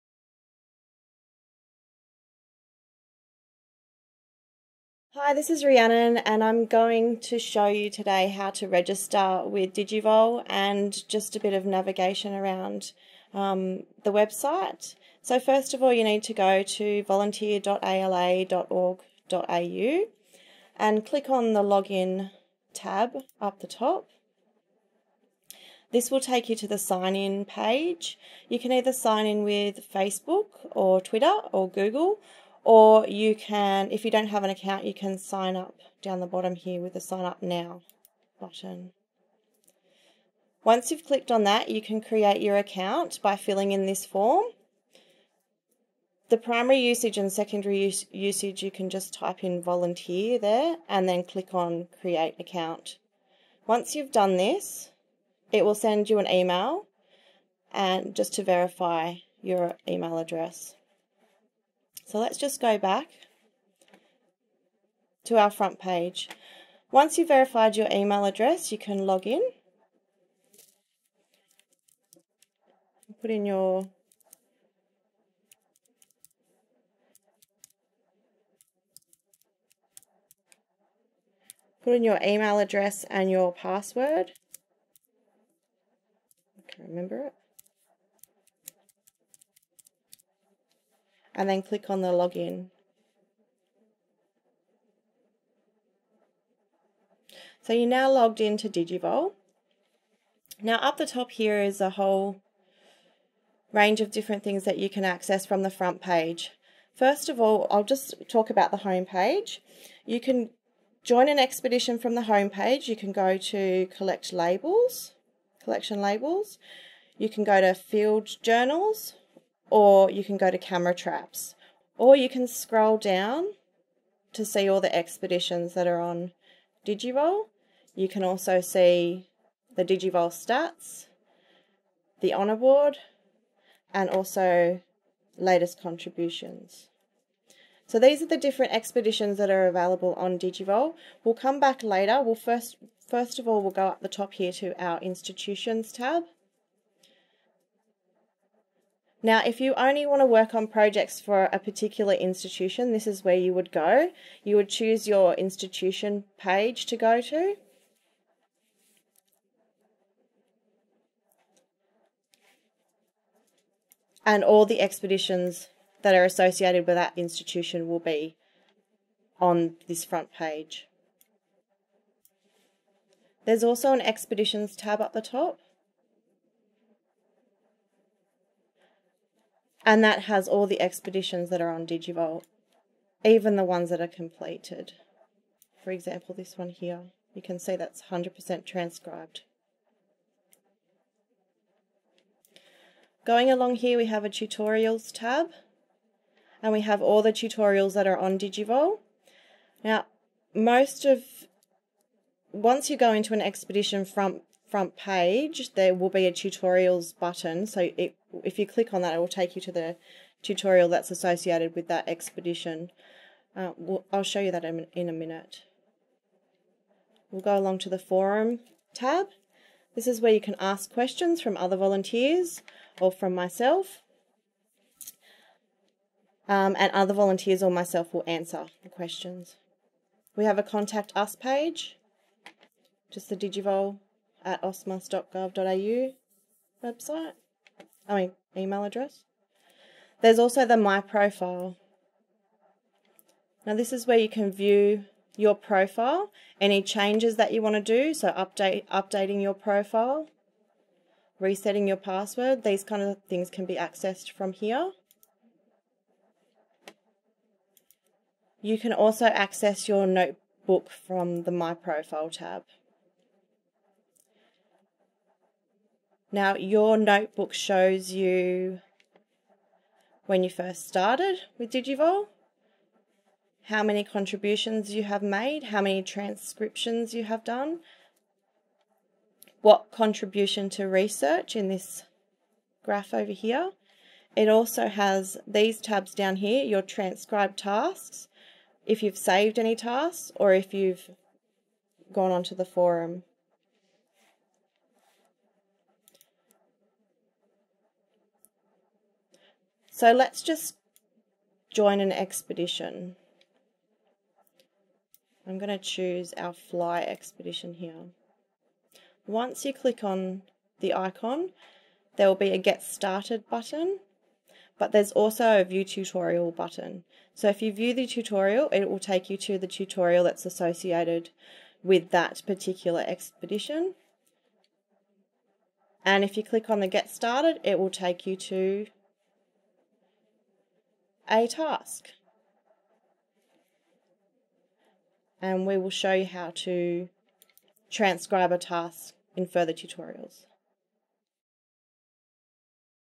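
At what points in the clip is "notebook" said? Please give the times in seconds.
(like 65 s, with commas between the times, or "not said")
260 s, 266 s.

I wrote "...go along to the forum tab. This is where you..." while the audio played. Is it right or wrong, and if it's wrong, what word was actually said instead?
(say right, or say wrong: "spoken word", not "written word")
right.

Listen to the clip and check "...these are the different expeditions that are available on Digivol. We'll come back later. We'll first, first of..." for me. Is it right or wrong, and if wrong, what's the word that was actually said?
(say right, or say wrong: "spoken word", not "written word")
right.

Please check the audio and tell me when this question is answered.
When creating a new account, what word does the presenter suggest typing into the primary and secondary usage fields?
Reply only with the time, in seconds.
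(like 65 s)
49 s.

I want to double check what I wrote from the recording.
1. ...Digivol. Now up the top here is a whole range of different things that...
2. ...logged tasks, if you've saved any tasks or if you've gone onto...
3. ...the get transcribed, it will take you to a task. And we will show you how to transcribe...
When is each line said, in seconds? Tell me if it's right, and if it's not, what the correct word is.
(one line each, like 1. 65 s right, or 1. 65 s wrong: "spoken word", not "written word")
1. 98 s right
2. 286 s wrong: "transcribed", not "logged"
3. 326 s wrong: "started", not "transcribed".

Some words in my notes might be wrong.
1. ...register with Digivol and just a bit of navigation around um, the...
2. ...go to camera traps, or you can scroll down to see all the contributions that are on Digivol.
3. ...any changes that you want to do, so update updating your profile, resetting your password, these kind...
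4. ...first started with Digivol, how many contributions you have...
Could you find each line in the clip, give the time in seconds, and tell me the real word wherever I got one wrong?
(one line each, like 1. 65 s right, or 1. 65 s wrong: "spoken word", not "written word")
1. 8 s right
2. 120 s wrong: "expeditions", not "contributions"
3. 246 s right
4. 270 s right.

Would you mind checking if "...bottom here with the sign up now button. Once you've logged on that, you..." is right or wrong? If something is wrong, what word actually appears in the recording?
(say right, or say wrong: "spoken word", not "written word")
wrong: "clicked", not "logged".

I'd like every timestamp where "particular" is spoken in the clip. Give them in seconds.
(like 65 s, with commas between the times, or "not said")
151 s, 322 s.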